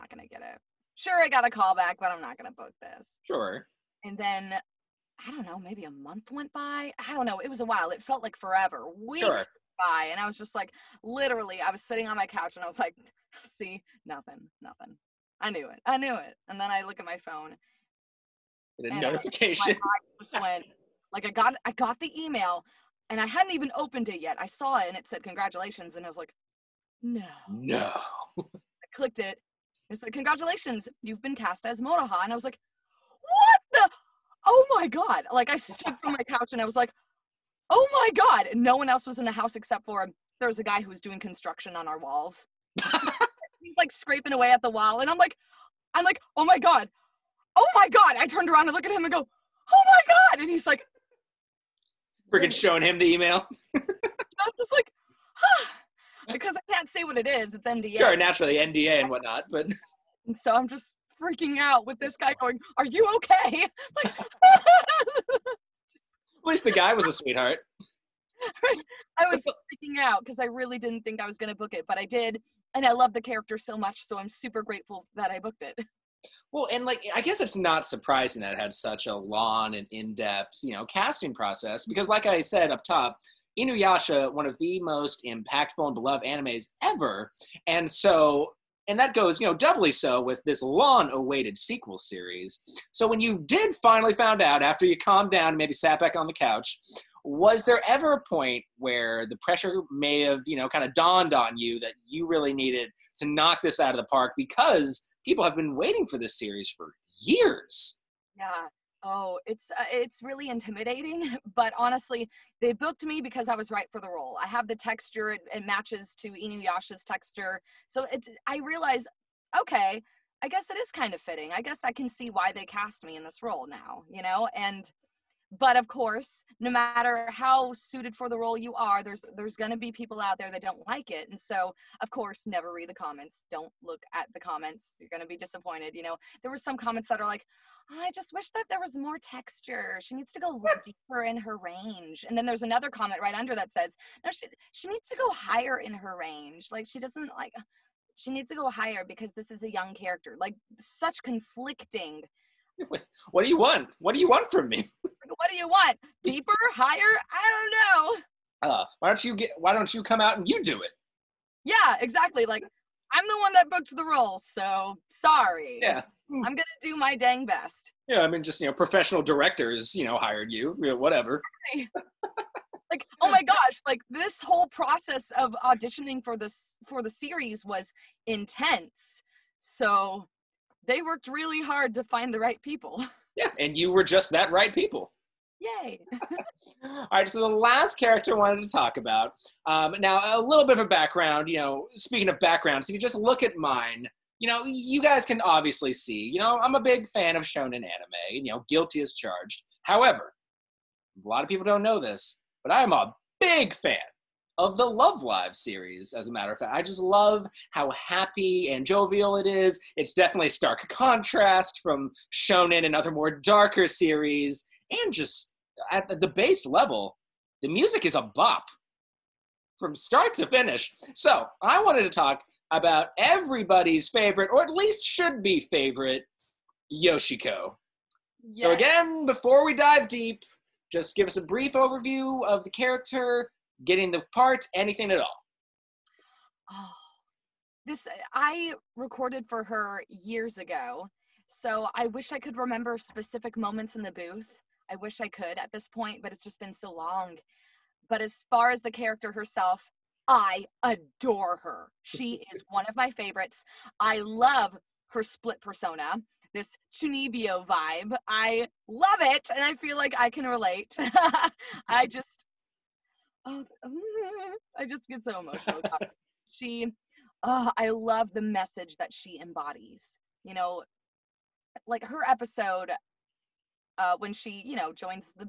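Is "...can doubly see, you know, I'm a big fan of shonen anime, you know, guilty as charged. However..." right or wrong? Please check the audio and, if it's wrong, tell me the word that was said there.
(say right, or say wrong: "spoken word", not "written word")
wrong: "obviously", not "doubly".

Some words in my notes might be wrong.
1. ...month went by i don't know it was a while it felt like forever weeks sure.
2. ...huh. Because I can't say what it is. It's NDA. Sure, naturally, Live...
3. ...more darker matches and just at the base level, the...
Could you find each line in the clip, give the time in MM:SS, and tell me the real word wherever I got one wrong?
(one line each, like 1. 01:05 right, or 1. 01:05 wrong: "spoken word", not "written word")
1. 00:05 right
2. 00:55 wrong: "NDA", not "Live"
3. 03:33 wrong: "series", not "matches".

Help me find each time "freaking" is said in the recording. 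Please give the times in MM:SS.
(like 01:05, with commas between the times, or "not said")
00:52, 01:01, 01:09.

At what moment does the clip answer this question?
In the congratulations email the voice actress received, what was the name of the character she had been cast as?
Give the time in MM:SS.
00:31.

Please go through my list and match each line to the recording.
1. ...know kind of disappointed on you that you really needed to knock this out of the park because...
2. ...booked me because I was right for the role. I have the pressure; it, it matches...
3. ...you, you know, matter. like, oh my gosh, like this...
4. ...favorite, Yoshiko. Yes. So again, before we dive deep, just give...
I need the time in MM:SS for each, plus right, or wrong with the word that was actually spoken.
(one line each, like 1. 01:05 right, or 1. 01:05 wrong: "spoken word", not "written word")
1. 01:40 wrong: "dawned", not "disappointed"
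2. 01:52 wrong: "texture", not "pressure"
3. 02:50 wrong: "whatever", not "matter"
4. 03:45 right.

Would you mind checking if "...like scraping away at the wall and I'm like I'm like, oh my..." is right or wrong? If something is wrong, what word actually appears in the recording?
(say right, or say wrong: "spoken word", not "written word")
right.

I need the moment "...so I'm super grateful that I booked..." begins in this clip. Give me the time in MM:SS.
01:14.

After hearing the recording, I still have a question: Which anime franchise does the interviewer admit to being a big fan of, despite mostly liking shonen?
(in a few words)
Love Live.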